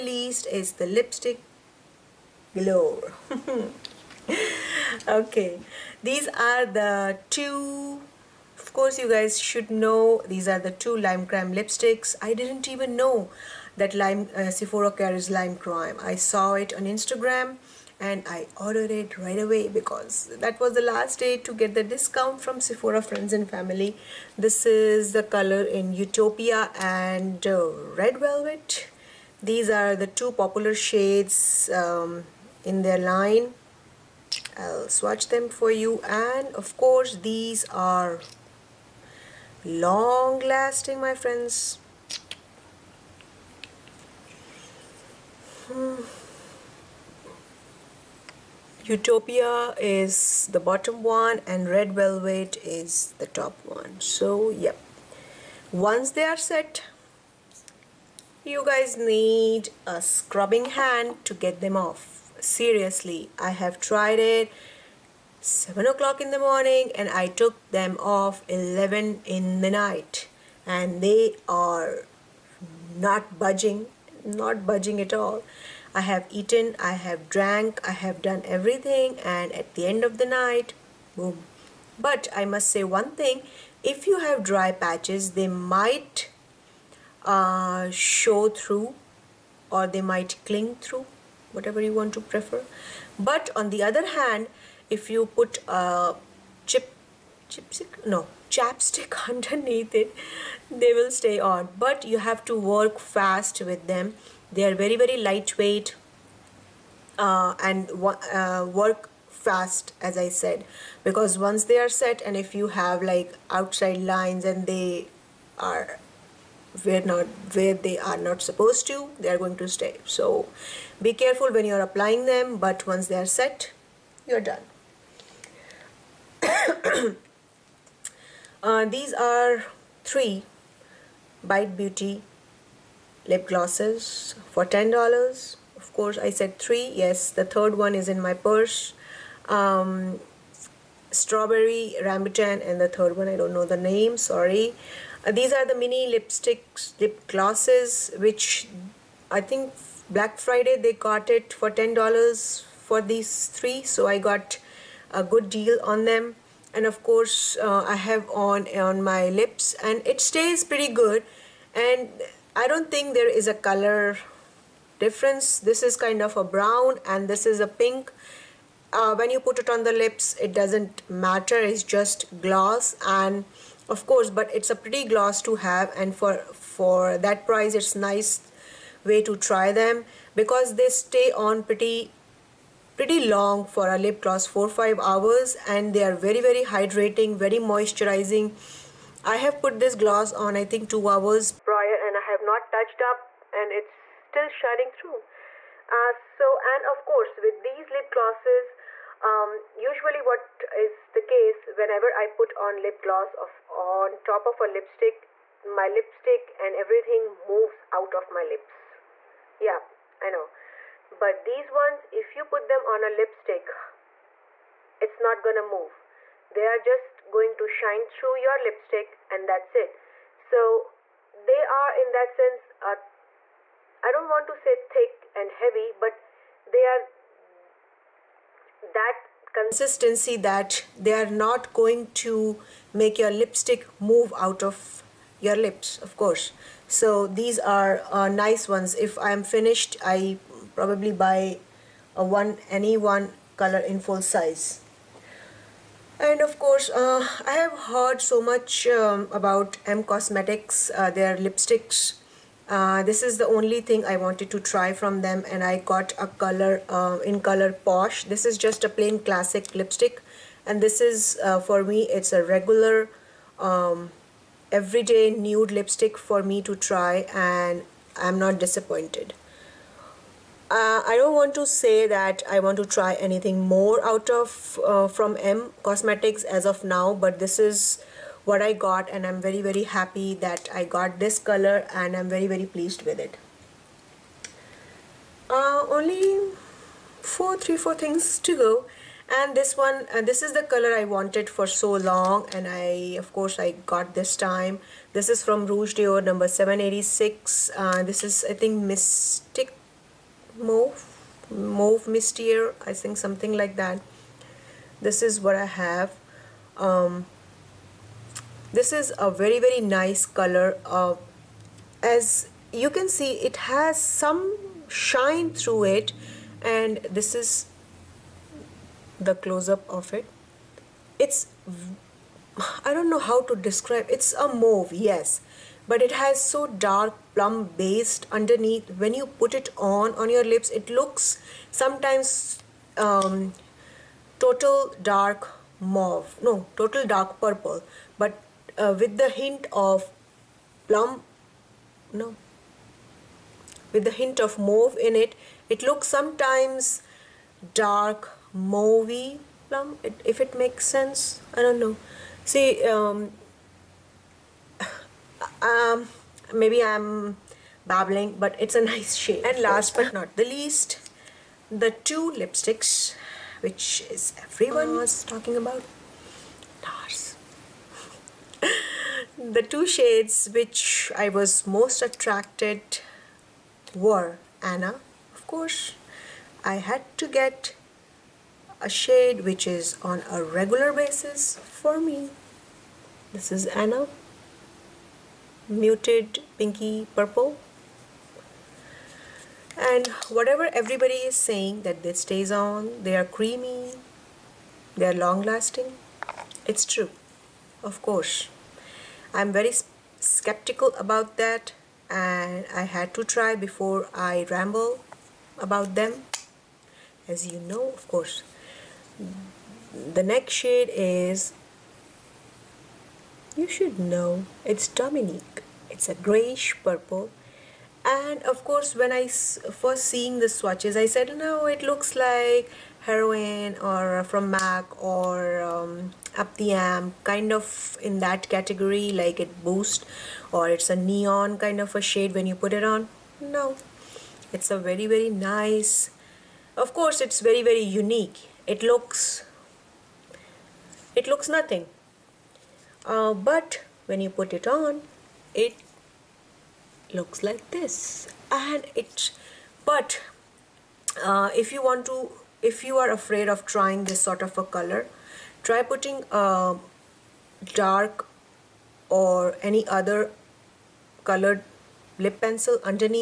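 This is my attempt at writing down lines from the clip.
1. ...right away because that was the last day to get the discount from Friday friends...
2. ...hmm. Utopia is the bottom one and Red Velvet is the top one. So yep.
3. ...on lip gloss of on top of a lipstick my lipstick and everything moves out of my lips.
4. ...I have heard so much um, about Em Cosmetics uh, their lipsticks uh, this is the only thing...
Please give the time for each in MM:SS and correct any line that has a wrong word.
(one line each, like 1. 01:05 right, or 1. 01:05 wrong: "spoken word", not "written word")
1. 00:19 wrong: "Sephora", not "Friday"
2. 00:45 right
3. 03:22 right
4. 04:07 right.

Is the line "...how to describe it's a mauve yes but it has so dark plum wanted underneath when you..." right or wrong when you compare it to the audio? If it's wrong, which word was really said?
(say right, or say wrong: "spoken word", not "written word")
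wrong: "based", not "wanted".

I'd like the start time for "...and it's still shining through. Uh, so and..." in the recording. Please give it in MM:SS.
03:13.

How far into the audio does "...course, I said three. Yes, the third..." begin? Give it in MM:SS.
02:15.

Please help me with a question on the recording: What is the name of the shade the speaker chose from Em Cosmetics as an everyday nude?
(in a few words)
Posh.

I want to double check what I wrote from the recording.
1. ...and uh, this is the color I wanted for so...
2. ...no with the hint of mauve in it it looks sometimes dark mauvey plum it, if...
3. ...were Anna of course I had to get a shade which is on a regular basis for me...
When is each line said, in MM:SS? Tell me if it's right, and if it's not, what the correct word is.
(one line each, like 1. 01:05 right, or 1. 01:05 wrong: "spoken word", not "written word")
1. 04:50 right
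2. 05:42 right
3. 06:13 right.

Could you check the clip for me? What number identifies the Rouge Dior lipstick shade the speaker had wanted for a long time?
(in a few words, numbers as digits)
786.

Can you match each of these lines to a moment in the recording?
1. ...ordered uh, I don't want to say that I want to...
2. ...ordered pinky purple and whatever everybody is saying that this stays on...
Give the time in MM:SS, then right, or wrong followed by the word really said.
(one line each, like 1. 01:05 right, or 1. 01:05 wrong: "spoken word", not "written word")
1. 04:28 wrong: "disappointed", not "ordered"
2. 06:25 wrong: "muted", not "ordered".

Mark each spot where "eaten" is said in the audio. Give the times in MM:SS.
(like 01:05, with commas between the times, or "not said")
01:16.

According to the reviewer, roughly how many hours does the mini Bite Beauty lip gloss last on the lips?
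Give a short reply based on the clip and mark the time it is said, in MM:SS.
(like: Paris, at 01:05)
4-5 hours, at 03:04.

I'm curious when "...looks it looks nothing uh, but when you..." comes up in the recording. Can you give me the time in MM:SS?
07:18.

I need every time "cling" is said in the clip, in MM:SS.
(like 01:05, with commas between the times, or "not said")
01:30.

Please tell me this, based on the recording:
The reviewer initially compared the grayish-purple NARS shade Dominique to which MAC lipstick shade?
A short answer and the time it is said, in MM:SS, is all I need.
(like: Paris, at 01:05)
Heroine, at 07:03.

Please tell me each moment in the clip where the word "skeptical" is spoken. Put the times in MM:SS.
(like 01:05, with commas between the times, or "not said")
06:40.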